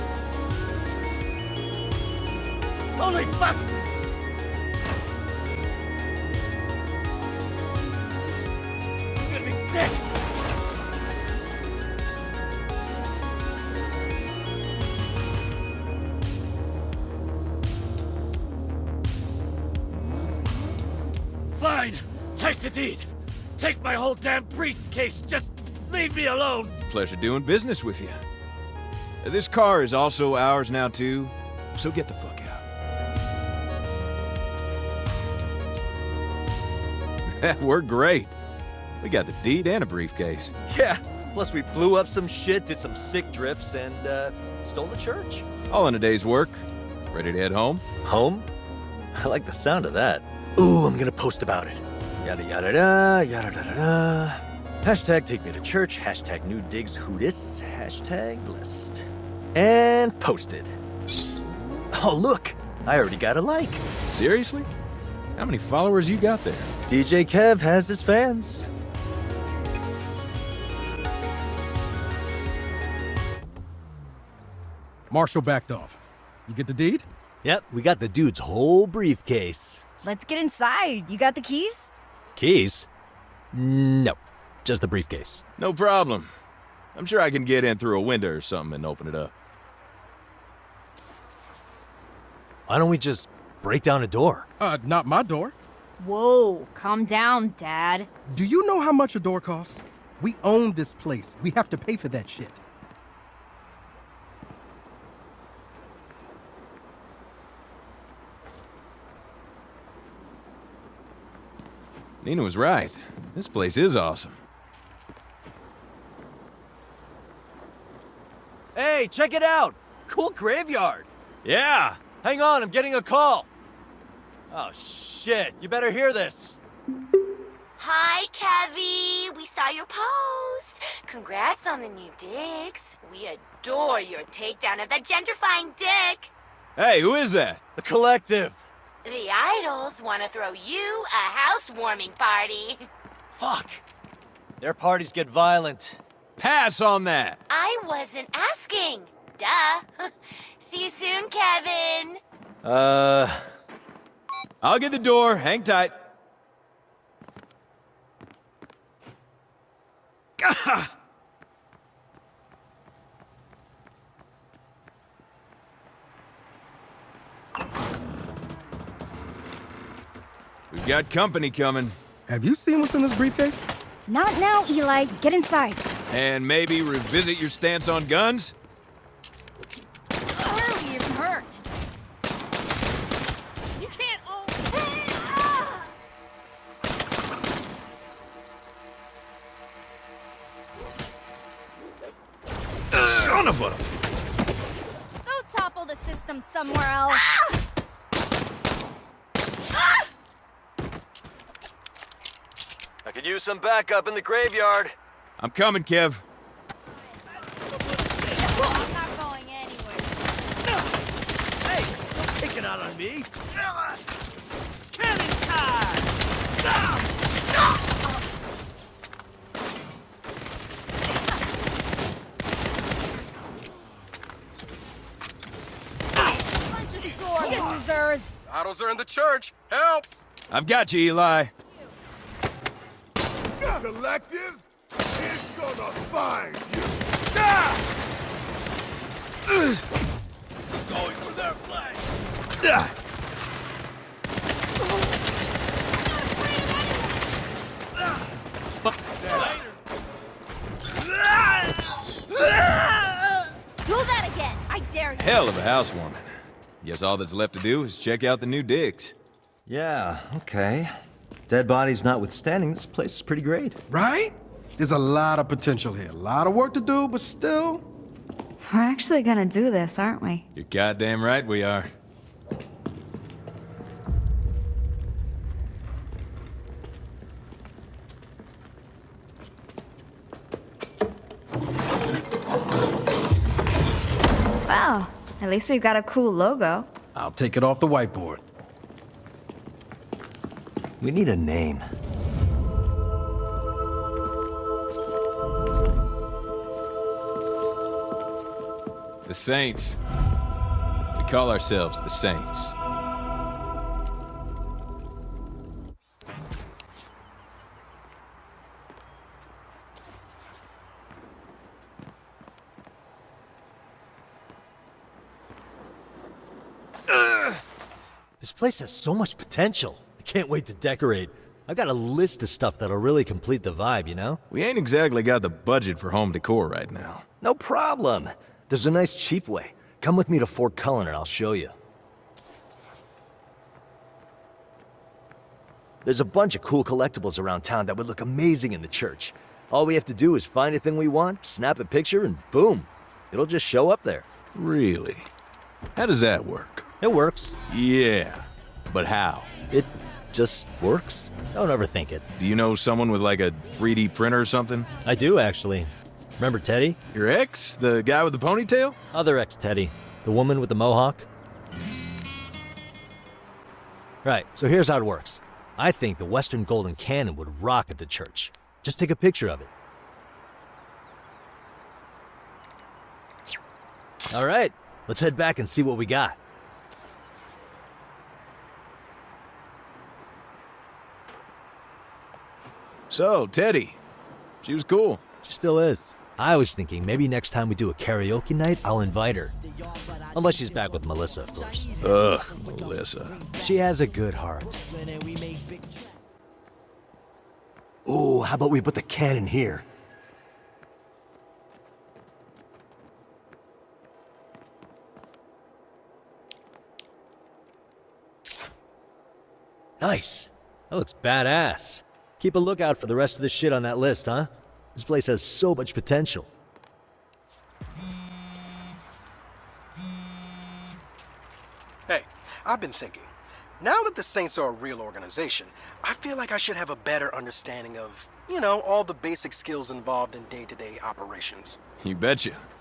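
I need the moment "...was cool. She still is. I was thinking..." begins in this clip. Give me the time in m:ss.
6:24.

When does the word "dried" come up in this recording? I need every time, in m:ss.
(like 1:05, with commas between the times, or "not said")
not said.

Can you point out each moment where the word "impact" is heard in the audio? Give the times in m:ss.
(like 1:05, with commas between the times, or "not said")
not said.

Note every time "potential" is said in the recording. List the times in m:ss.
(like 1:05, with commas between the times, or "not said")
4:25, 5:19, 6:55.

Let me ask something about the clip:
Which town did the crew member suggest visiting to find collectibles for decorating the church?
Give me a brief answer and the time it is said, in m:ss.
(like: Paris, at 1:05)
Fort Cullen, at 5:30.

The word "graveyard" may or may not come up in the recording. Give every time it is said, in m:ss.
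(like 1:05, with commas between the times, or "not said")
2:00, 3:24.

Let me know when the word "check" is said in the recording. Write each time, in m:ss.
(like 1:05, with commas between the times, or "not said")
1:59, 4:17.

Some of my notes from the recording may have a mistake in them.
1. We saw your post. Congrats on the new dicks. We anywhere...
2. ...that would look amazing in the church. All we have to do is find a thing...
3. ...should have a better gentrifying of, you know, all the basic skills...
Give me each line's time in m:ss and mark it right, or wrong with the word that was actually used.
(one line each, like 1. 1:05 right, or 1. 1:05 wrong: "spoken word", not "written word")
1. 2:09 wrong: "adore", not "anywhere"
2. 5:37 right
3. 7:06 wrong: "understanding", not "gentrifying".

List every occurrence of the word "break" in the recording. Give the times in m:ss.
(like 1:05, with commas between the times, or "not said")
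1:33.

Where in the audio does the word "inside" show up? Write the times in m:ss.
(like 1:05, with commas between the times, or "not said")
1:20, 2:55.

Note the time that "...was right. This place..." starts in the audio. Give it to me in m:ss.
1:52.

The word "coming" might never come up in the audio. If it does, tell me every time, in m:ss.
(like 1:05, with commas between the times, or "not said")
2:51, 3:25.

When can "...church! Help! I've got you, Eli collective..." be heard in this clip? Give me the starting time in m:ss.
3:49.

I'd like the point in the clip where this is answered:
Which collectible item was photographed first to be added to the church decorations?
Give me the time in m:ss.
6:06.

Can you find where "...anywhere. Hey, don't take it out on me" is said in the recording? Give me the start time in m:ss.
3:29.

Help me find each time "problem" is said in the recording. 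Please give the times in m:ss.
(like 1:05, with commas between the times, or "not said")
1:25, 5:27.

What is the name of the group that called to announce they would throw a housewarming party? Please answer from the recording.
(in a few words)
The Collective.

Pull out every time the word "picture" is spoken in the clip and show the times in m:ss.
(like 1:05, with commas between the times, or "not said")
5:41, 6:09.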